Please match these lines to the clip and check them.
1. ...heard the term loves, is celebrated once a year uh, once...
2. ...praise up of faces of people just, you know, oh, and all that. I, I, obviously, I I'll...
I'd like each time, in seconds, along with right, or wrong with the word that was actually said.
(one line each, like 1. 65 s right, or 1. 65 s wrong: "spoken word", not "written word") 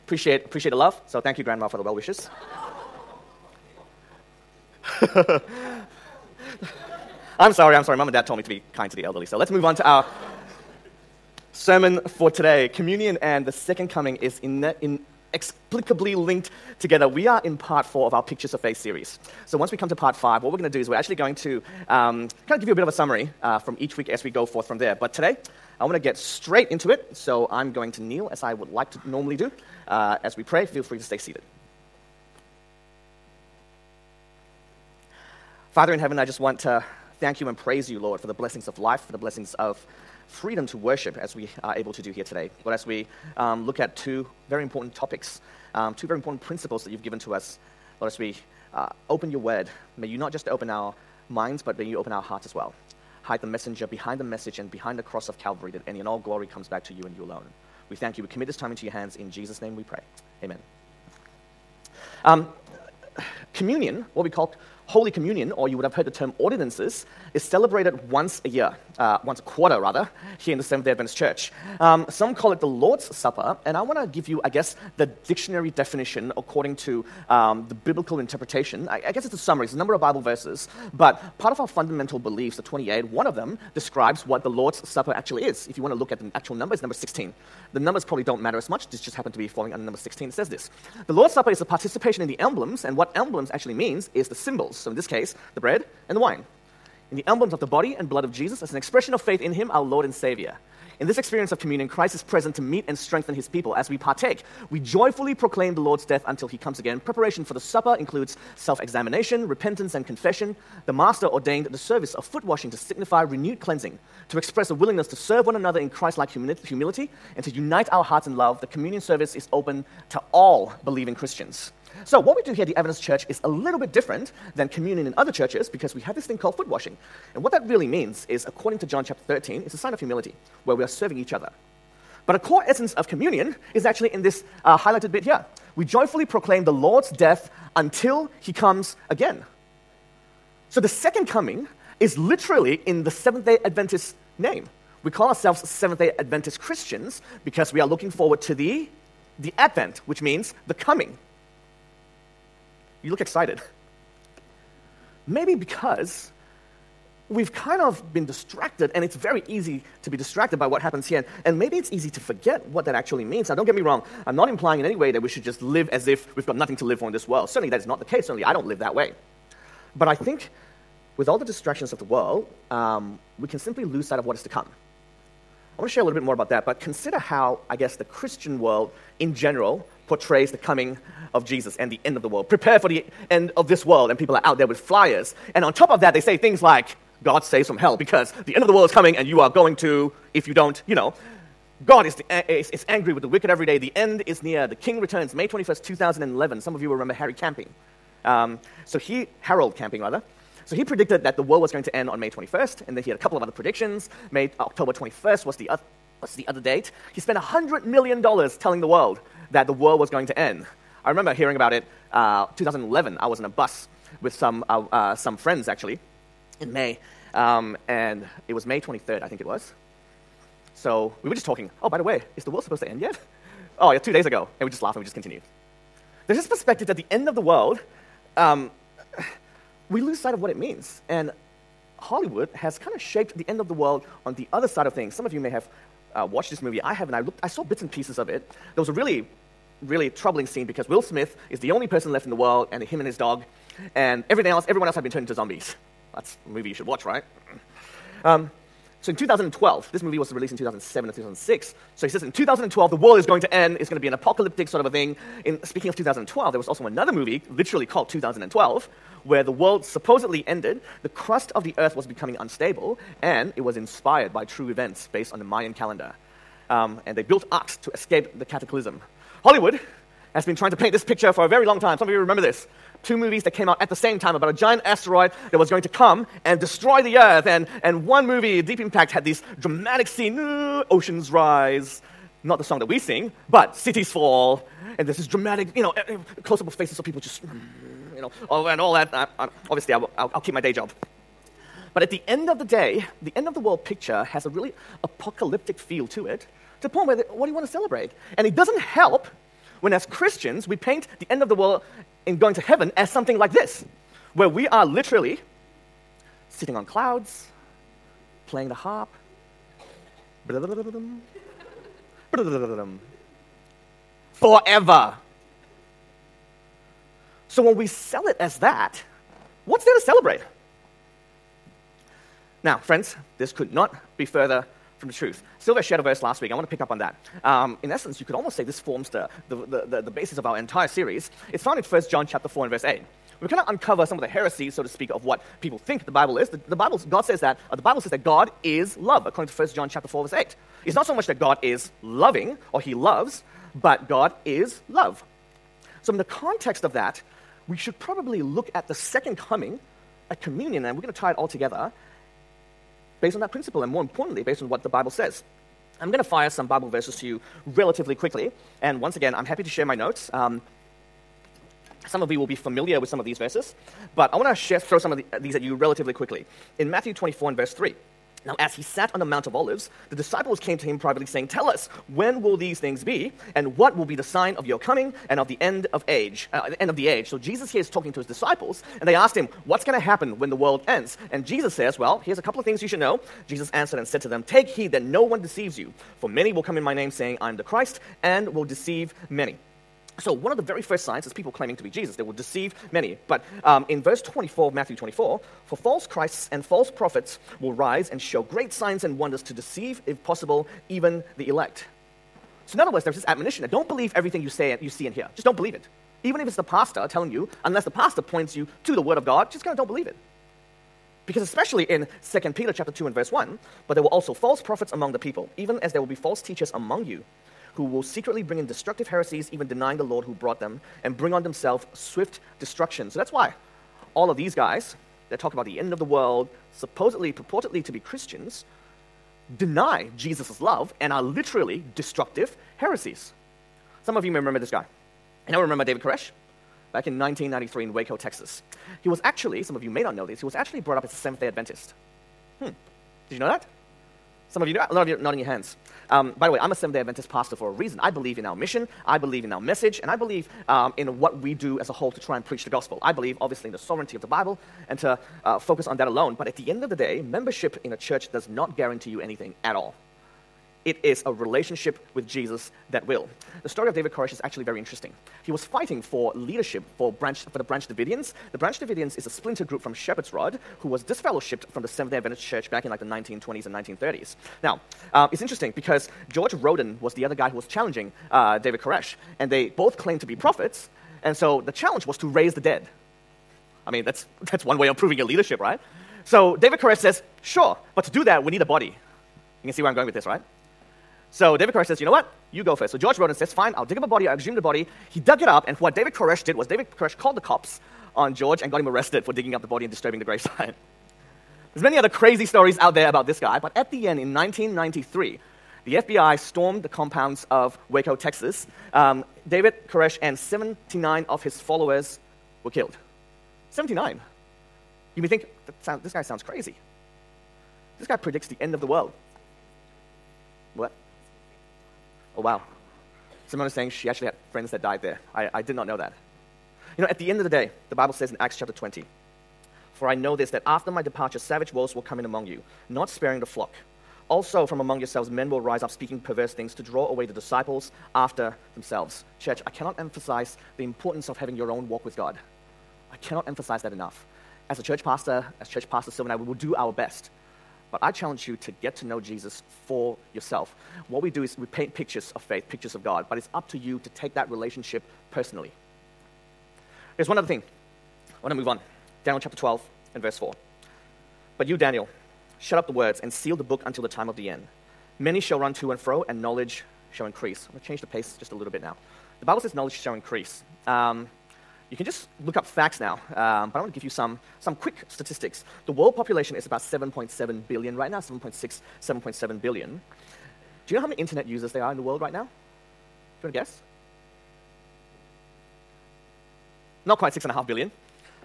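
1. 65 s wrong: "ordinances", not "loves"
2. 286 s wrong: "close", not "praise".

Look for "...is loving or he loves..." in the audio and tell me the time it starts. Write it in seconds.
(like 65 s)
341 s.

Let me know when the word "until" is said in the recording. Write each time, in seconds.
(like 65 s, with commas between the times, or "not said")
106 s, 137 s, 563 s.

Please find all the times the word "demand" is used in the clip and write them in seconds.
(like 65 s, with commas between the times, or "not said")
not said.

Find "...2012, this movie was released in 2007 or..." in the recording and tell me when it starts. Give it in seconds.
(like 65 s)
249 s.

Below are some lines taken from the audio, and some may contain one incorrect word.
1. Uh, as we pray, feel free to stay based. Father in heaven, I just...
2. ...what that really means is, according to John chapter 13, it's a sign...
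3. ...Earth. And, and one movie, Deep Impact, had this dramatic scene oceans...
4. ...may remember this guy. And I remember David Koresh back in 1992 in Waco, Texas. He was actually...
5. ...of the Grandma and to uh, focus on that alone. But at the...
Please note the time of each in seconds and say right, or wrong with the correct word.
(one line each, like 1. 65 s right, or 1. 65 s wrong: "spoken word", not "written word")
1. 29 s wrong: "seated", not "based"
2. 127 s right
3. 277 s right
4. 434 s wrong: "1993", not "1992"
5. 454 s wrong: "Bible", not "Grandma".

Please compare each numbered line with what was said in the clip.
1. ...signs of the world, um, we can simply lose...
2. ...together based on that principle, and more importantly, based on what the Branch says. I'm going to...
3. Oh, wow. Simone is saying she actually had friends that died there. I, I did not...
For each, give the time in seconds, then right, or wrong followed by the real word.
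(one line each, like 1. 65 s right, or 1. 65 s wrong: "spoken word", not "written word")
1. 171 s wrong: "distractions", not "signs"
2. 351 s wrong: "Bible", not "Branch"
3. 522 s right.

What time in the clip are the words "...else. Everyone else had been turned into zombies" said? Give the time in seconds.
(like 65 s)
244 s.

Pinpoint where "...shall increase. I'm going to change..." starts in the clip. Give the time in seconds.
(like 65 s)
567 s.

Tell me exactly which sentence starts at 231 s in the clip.
And Hollywood has kind of shaped the end of the world on the other side of things.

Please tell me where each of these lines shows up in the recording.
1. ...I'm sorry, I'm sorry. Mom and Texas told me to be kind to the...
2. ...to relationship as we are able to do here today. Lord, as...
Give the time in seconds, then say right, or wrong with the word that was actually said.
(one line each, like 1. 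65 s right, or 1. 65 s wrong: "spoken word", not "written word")
1. 7 s wrong: "Dad", not "Texas"
2. 40 s wrong: "worship", not "relationship".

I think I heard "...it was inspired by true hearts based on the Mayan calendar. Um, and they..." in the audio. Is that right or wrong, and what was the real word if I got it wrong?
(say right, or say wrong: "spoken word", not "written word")
wrong: "events", not "hearts".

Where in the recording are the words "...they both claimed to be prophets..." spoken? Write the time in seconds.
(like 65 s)
479 s.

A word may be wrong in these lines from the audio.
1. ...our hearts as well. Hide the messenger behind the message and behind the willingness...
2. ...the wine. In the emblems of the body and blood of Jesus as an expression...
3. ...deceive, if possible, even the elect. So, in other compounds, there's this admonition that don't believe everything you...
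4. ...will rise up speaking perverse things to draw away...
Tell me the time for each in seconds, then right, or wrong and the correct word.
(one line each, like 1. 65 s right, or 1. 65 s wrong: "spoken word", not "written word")
1. 52 s wrong: "cross", not "willingness"
2. 96 s right
3. 399 s wrong: "words", not "compounds"
4. 535 s right.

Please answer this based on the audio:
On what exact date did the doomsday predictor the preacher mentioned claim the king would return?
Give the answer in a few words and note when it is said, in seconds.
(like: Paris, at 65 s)
May 21st, 2011, at 195 s.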